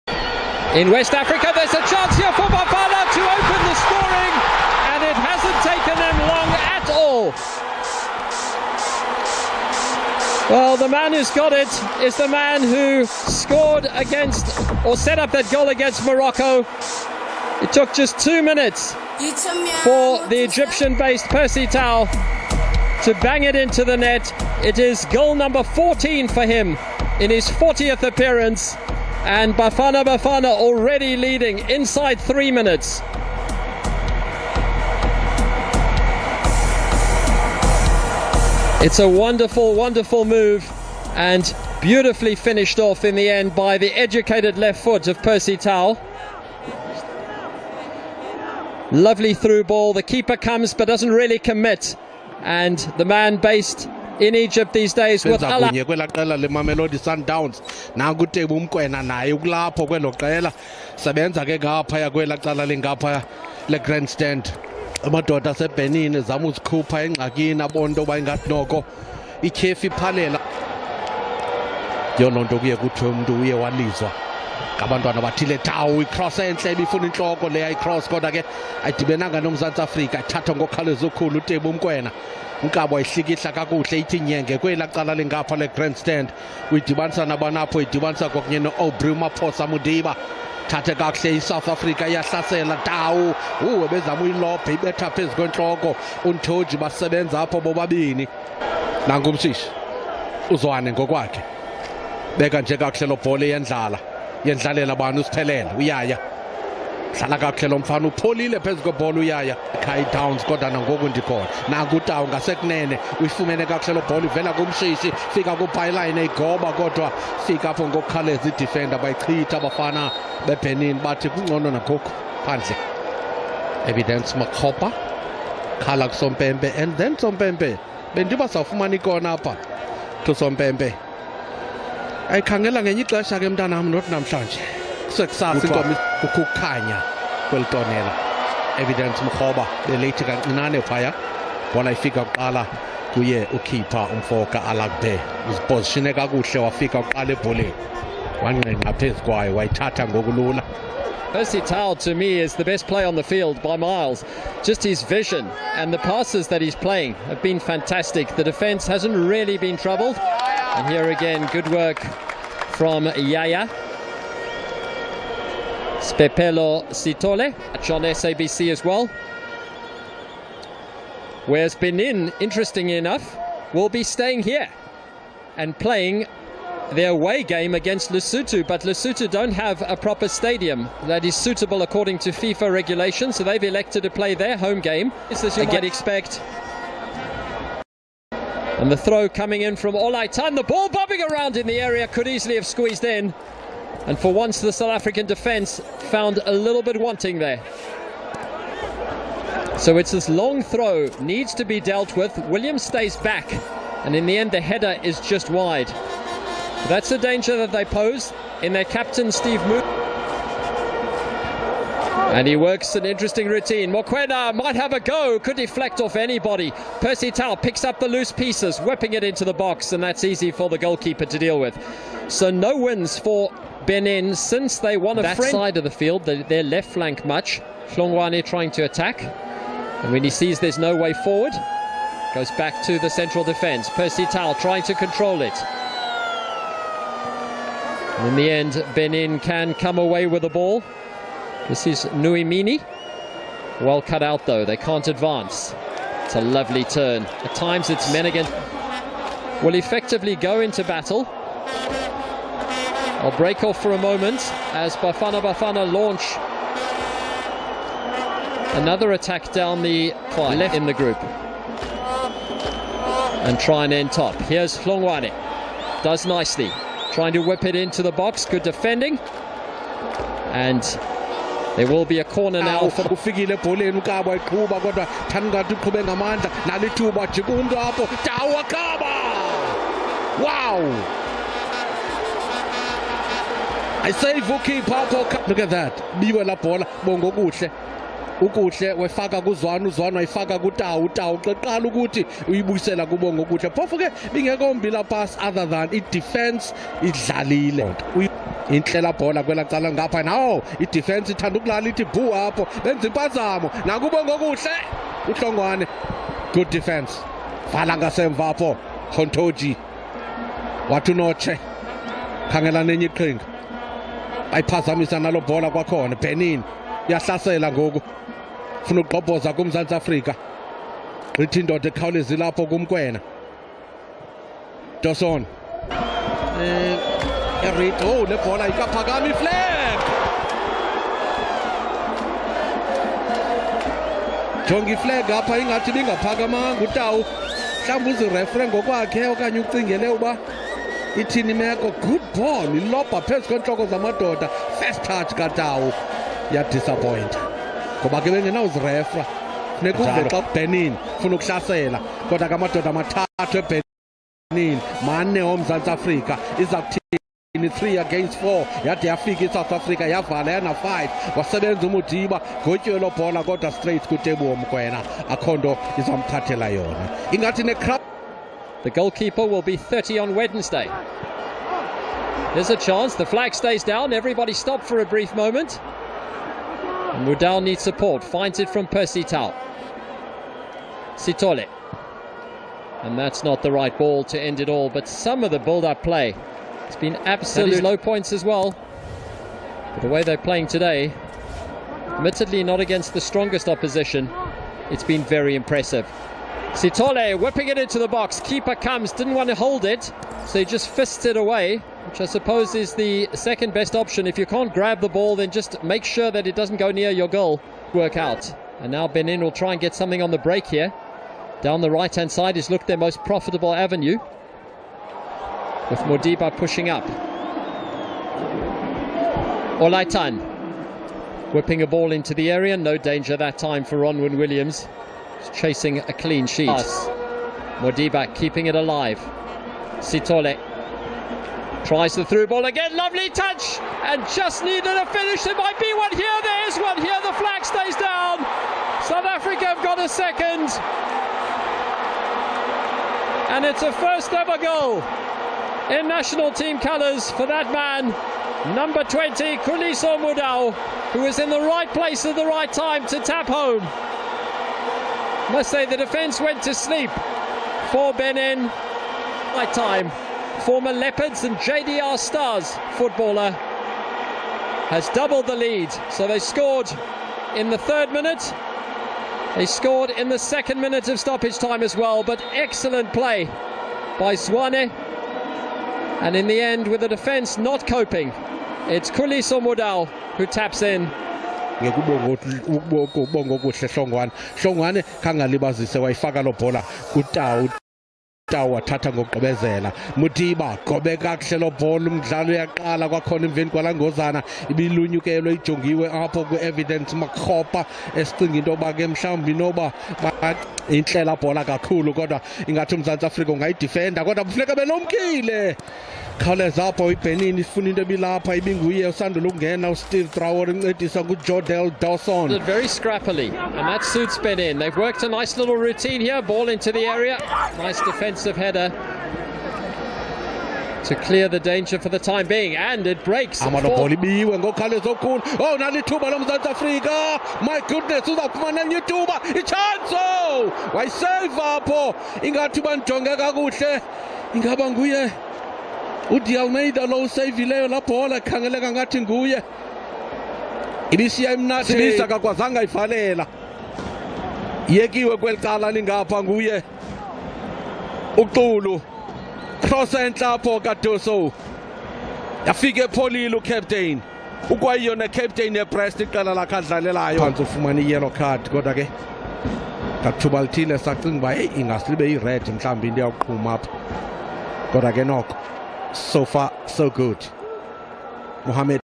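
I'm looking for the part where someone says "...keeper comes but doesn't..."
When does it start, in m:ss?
0:50.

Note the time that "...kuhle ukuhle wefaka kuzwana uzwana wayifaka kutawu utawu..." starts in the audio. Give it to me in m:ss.
4:47.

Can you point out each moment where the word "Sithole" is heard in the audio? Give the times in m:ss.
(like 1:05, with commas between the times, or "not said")
2:46, 6:21, 6:36, 7:09.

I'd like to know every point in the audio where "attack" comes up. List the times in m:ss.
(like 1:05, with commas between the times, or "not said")
3:48, 4:19.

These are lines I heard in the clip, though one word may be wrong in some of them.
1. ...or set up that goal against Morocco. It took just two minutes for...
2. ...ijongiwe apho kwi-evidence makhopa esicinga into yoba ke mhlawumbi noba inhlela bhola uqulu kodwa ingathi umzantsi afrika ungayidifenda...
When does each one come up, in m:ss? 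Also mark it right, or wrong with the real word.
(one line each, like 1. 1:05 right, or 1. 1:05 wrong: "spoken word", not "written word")
1. 0:14 right
2. 8:15 wrong: "kakhulu", not "uqulu".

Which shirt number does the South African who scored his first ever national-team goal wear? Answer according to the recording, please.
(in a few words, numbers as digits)
20.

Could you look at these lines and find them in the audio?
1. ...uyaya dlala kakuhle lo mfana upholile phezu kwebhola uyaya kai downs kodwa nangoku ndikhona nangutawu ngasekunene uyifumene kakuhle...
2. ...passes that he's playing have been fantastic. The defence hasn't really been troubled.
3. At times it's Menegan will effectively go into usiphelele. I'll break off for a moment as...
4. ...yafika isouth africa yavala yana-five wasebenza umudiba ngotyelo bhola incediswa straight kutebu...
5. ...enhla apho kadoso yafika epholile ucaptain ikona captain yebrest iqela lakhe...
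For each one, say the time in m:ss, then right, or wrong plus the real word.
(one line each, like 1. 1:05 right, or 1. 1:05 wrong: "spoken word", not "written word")
1. 1:45 right
2. 2:35 right
3. 4:07 wrong: "battle", not "usiphelele"
4. 5:59 wrong: "kodwa", not "incediswa"
5. 9:10 wrong: "ukwayiyona", not "ikona".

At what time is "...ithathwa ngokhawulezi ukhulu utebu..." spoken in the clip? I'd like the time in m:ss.
1:20.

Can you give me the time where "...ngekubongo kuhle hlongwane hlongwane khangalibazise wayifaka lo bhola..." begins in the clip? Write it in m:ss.
8:01.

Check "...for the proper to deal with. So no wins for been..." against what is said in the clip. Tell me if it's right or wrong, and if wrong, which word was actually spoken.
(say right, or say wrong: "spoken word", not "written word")
wrong: "goalkeeper", not "proper".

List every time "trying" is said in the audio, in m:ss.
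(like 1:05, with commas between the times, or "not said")
3:48, 3:54, 4:27.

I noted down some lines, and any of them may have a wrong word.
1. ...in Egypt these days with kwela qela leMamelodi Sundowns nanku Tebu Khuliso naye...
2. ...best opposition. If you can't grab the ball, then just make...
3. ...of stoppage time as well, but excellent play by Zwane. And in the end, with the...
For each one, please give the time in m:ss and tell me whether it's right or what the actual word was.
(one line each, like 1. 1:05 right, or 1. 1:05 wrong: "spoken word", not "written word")
1. 0:54 wrong: "Mkwena", not "Khuliso"
2. 6:43 wrong: "option", not "opposition"
3. 7:51 right.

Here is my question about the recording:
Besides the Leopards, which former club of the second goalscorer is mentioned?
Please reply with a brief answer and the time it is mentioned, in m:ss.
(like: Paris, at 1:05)
JDR Stars, at 7:41.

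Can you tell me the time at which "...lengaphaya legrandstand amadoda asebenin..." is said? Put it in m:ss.
1:02.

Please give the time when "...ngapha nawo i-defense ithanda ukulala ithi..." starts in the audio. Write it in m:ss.
4:59.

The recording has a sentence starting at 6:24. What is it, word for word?
But some of the build-up play has been absolute low points as well.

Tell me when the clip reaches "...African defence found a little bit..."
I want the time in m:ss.
3:14.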